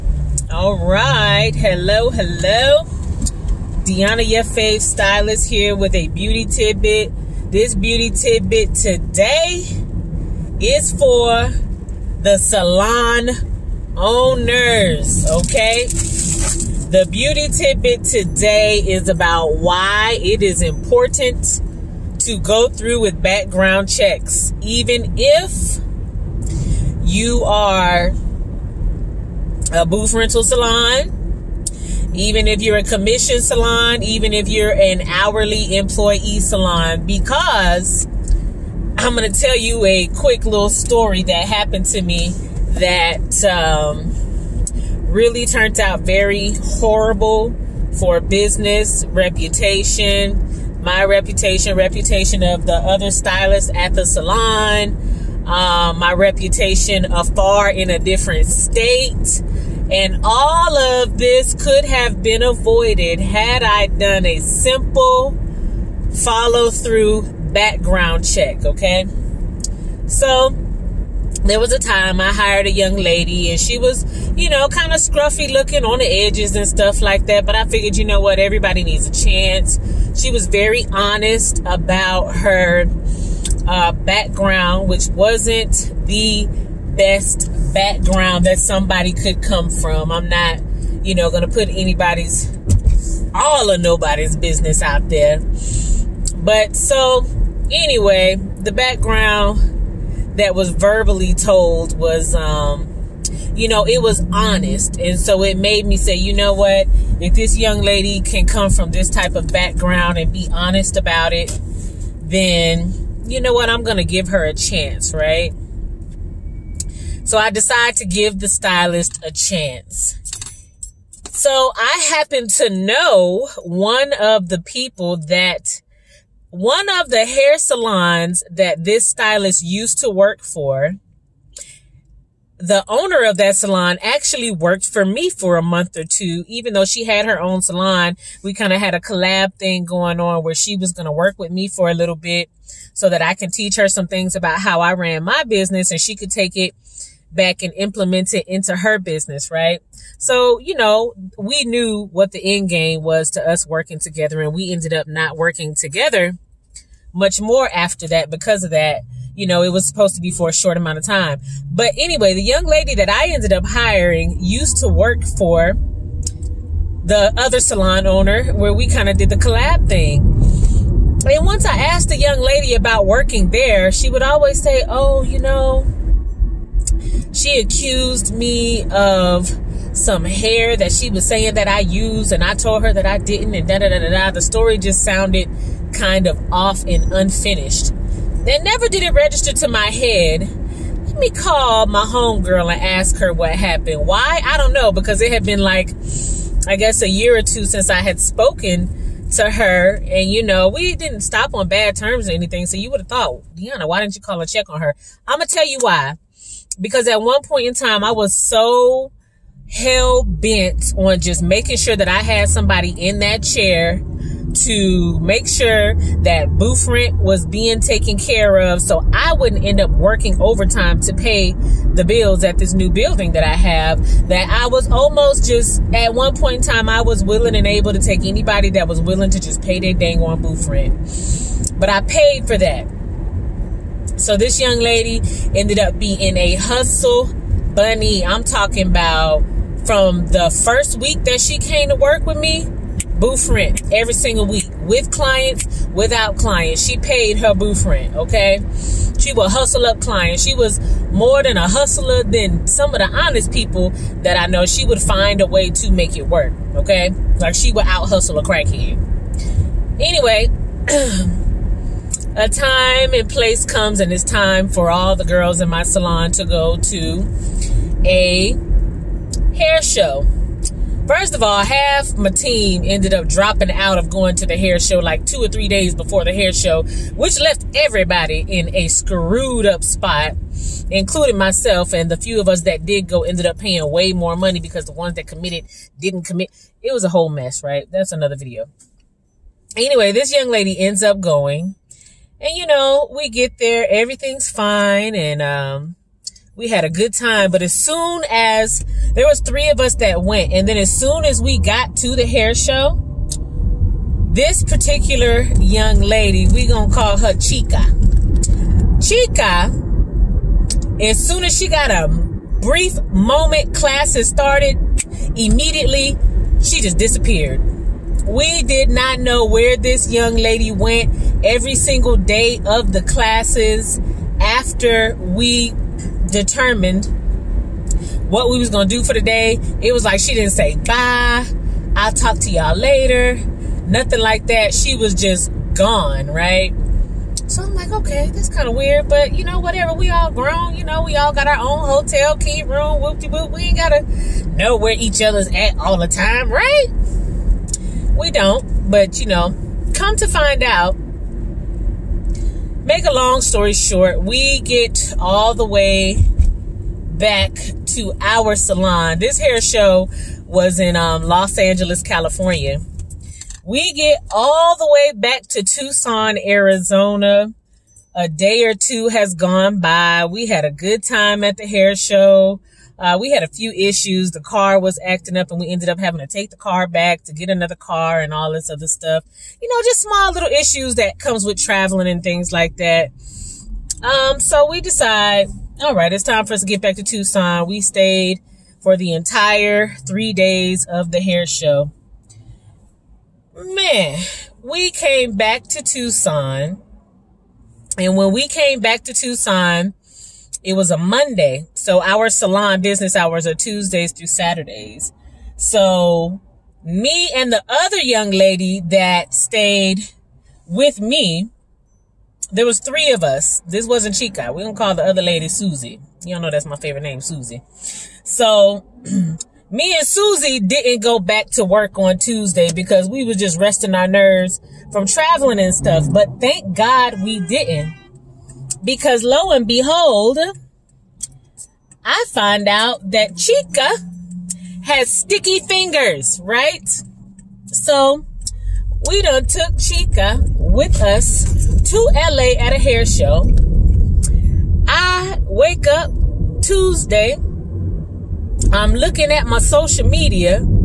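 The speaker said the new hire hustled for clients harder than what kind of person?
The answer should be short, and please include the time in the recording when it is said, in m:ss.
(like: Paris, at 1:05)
a crackhead, at 4:18.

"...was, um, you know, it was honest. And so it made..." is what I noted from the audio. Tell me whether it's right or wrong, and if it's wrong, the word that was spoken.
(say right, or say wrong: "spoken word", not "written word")
right.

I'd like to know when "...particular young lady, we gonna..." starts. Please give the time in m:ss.
5:04.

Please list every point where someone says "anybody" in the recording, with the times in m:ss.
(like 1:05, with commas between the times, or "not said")
1:31, 3:48.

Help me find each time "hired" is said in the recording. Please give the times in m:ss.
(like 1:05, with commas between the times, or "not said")
1:12.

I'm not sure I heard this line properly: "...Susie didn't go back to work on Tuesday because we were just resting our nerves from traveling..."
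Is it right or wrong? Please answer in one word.
right.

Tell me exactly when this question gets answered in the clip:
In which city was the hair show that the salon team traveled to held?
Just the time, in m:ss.
6:01.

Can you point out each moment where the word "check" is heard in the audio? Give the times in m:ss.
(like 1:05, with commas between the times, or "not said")
0:23, 1:08, 3:24.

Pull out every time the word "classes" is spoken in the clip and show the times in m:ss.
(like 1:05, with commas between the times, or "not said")
5:13, 5:23.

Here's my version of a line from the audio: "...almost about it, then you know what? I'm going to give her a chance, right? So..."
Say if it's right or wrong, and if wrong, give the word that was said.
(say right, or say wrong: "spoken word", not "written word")
wrong: "honest", not "almost".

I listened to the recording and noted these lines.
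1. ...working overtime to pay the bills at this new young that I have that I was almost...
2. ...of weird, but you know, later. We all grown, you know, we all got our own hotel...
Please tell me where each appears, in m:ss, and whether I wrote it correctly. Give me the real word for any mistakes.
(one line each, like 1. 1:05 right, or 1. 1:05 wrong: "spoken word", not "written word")
1. 3:39 wrong: "building", not "young"
2. 5:38 wrong: "whatever", not "later".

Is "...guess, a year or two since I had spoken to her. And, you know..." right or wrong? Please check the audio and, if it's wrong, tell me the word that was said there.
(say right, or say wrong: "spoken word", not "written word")
right.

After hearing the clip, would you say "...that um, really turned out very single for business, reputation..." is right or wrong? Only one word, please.
wrong.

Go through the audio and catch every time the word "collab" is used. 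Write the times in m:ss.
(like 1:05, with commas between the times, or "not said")
2:18, 2:49.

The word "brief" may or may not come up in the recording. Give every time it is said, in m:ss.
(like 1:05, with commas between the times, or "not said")
5:12.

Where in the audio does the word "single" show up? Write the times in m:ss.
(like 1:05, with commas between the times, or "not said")
4:04, 5:21.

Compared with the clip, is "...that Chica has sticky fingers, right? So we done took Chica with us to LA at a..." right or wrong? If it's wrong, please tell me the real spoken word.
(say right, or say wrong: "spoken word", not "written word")
right.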